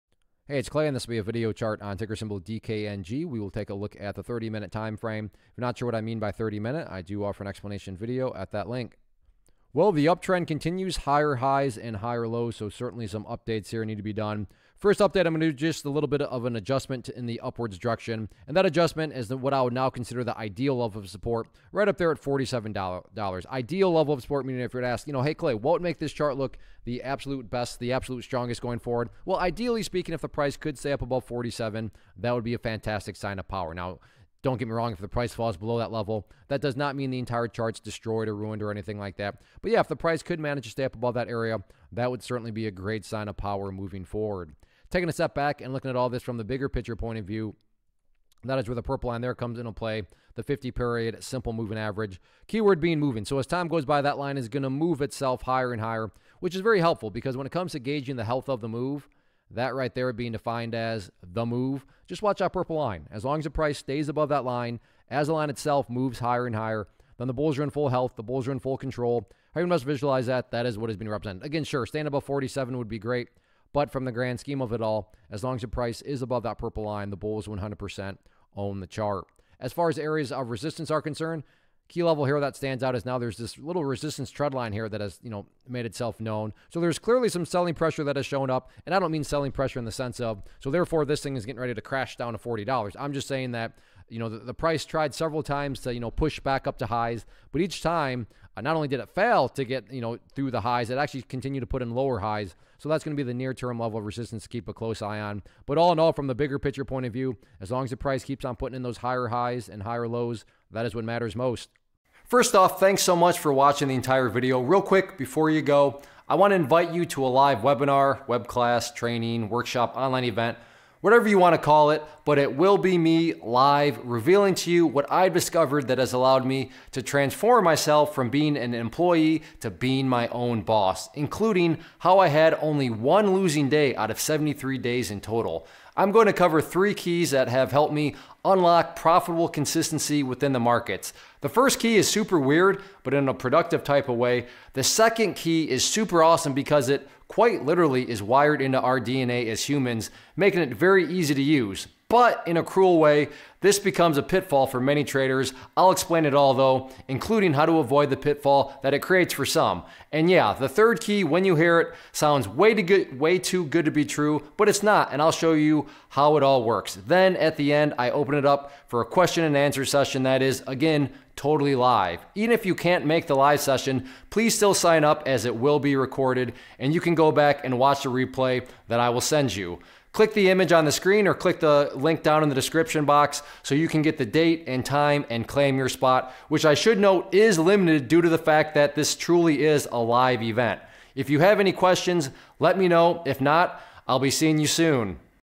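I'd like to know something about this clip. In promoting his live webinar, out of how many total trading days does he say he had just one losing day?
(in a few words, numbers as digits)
73.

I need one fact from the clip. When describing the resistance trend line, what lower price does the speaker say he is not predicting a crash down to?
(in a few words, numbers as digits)
$40.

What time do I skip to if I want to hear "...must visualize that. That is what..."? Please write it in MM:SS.
01:09.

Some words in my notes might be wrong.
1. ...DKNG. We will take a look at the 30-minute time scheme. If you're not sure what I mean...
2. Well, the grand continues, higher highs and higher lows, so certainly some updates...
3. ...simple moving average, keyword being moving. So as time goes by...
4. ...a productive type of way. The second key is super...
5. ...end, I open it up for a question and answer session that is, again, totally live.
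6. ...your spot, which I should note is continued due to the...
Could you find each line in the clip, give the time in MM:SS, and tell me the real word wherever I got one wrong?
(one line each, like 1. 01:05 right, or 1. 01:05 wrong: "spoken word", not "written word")
1. 00:02 wrong: "frame", not "scheme"
2. 00:09 wrong: "uptrend", not "grand"
3. 00:51 right
4. 02:23 right
5. 02:47 right
6. 03:05 wrong: "limited", not "continued".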